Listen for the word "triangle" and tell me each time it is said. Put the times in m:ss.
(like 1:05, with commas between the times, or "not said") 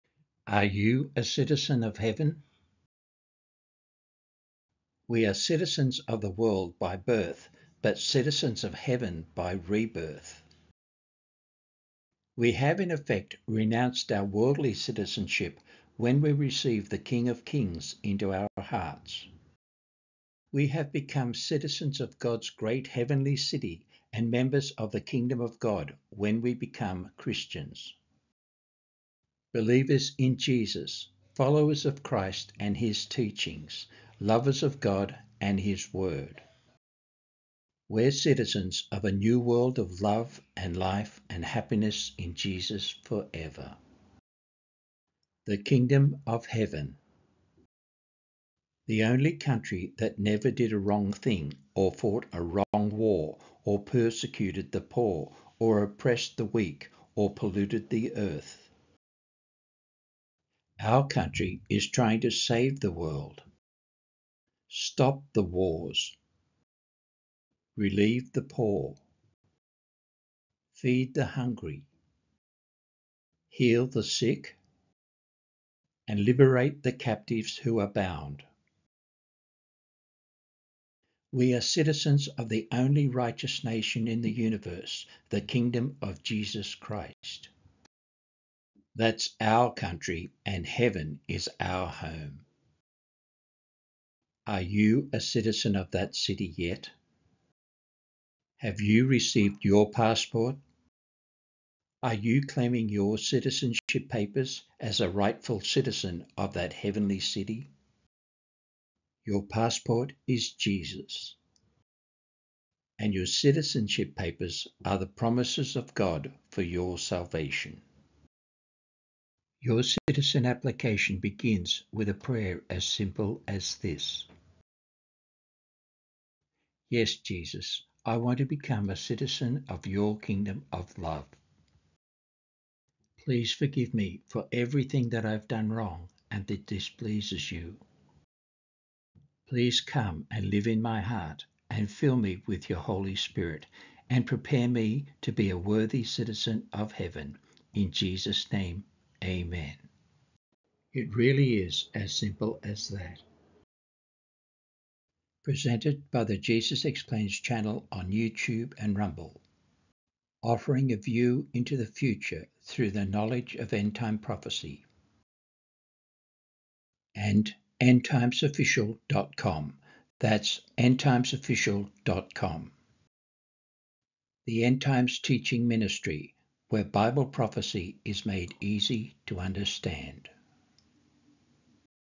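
not said.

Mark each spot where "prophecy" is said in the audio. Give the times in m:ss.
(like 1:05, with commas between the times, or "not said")
2:44, 2:57.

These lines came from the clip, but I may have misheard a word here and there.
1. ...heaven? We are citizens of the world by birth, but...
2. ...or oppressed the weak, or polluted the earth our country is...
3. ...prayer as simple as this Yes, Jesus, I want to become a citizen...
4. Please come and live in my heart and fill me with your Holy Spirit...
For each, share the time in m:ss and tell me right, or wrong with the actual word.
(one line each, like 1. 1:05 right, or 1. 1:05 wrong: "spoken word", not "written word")
1. 0:01 right
2. 0:55 right
3. 2:02 right
4. 2:19 right.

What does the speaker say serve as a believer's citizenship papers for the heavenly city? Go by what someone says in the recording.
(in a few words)
the promises of God.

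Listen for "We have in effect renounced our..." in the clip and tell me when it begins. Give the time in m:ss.
0:12.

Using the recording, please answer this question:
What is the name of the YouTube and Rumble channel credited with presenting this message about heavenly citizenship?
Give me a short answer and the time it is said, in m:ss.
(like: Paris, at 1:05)
Jesus Explains, at 2:36.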